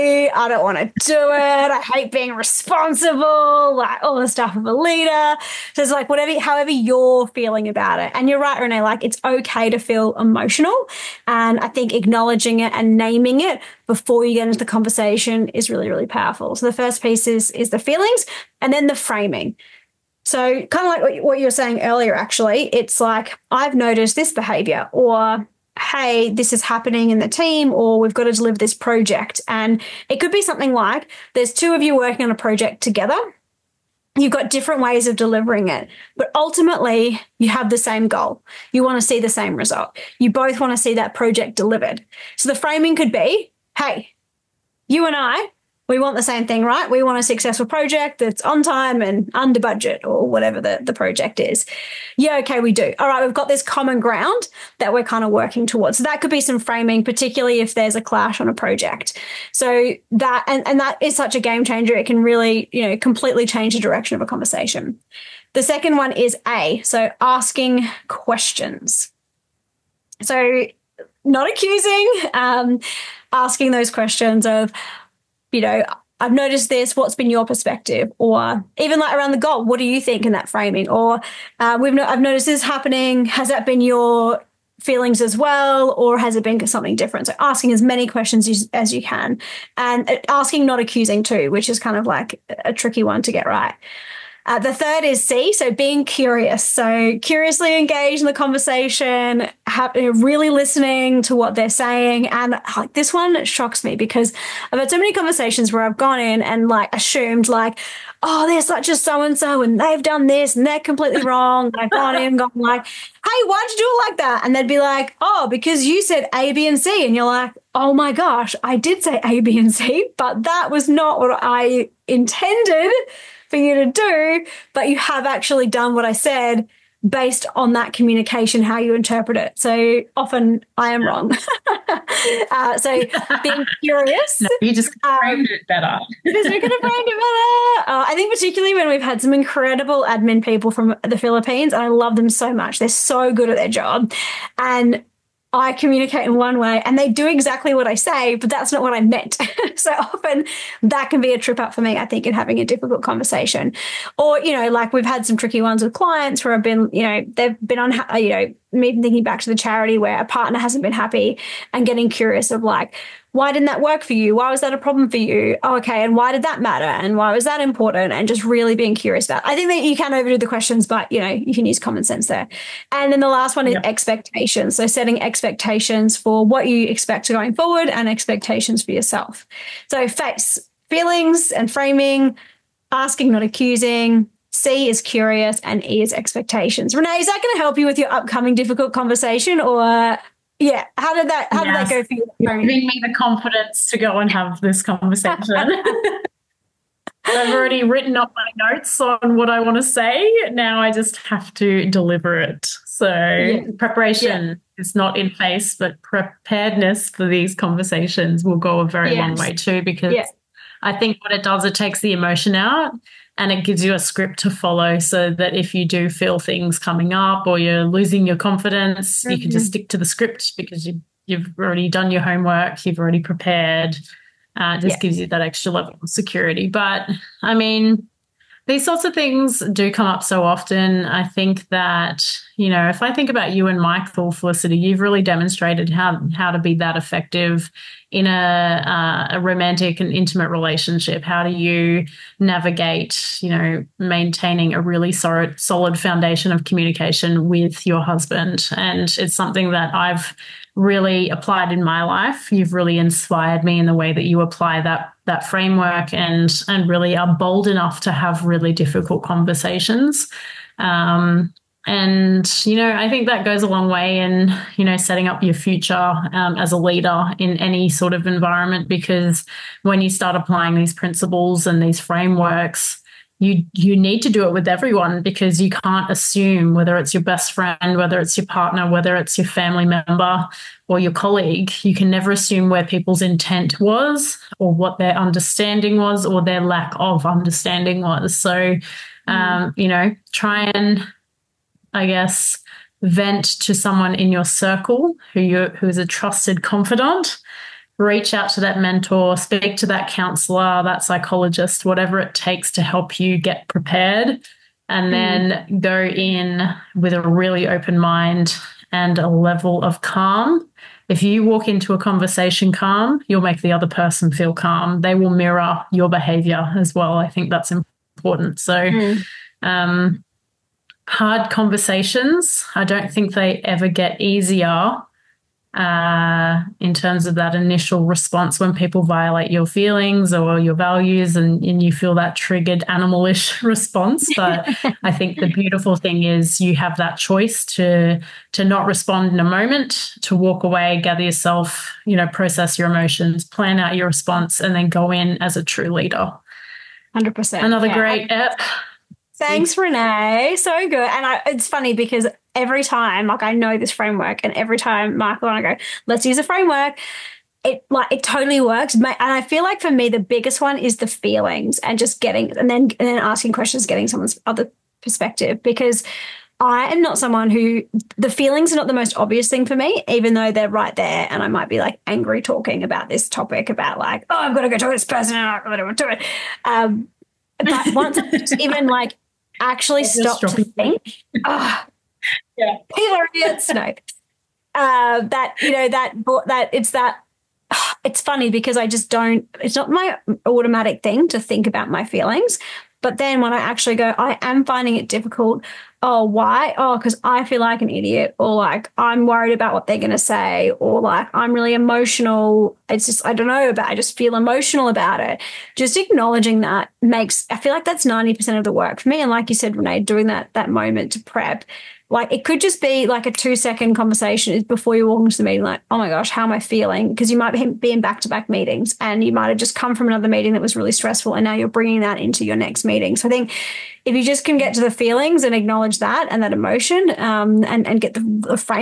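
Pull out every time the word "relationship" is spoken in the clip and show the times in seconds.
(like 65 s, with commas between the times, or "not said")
240 s.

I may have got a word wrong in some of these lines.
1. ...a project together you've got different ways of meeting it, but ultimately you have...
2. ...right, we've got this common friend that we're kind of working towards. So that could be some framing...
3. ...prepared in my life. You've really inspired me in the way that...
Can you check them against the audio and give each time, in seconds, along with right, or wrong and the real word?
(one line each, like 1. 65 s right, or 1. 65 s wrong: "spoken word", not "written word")
1. 32 s wrong: "delivering", not "meeting"
2. 53 s wrong: "ground", not "friend"
3. 251 s wrong: "applied", not "prepared".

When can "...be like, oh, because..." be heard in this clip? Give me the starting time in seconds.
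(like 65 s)
114 s.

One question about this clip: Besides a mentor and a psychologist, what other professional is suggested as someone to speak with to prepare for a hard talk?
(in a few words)
Counselor.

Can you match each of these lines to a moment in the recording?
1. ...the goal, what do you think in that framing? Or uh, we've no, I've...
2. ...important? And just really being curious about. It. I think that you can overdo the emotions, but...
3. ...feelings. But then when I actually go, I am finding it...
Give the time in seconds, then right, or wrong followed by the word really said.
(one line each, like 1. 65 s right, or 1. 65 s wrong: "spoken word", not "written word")
1. 79 s right
2. 167 s wrong: "questions", not "emotions"
3. 392 s right.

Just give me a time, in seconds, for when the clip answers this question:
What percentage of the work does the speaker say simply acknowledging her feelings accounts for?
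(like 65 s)
408 s.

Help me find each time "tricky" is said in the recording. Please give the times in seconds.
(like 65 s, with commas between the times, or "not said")
92 s, 155 s.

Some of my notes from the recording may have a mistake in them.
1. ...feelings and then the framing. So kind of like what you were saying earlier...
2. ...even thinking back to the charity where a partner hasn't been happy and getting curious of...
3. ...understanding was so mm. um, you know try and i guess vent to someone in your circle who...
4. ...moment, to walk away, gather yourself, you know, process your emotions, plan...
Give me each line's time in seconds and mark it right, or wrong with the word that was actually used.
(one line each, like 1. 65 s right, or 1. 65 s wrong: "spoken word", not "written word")
1. 17 s right
2. 158 s right
3. 287 s right
4. 339 s right.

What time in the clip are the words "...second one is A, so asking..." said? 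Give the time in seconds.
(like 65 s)
65 s.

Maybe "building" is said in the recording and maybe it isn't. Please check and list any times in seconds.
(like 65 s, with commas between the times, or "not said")
not said.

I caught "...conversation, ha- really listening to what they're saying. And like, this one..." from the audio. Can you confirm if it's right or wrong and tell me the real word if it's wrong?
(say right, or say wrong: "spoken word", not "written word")
right.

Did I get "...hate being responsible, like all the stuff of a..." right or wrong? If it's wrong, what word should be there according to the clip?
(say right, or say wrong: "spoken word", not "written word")
right.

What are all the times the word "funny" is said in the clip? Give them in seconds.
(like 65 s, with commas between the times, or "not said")
351 s, 388 s.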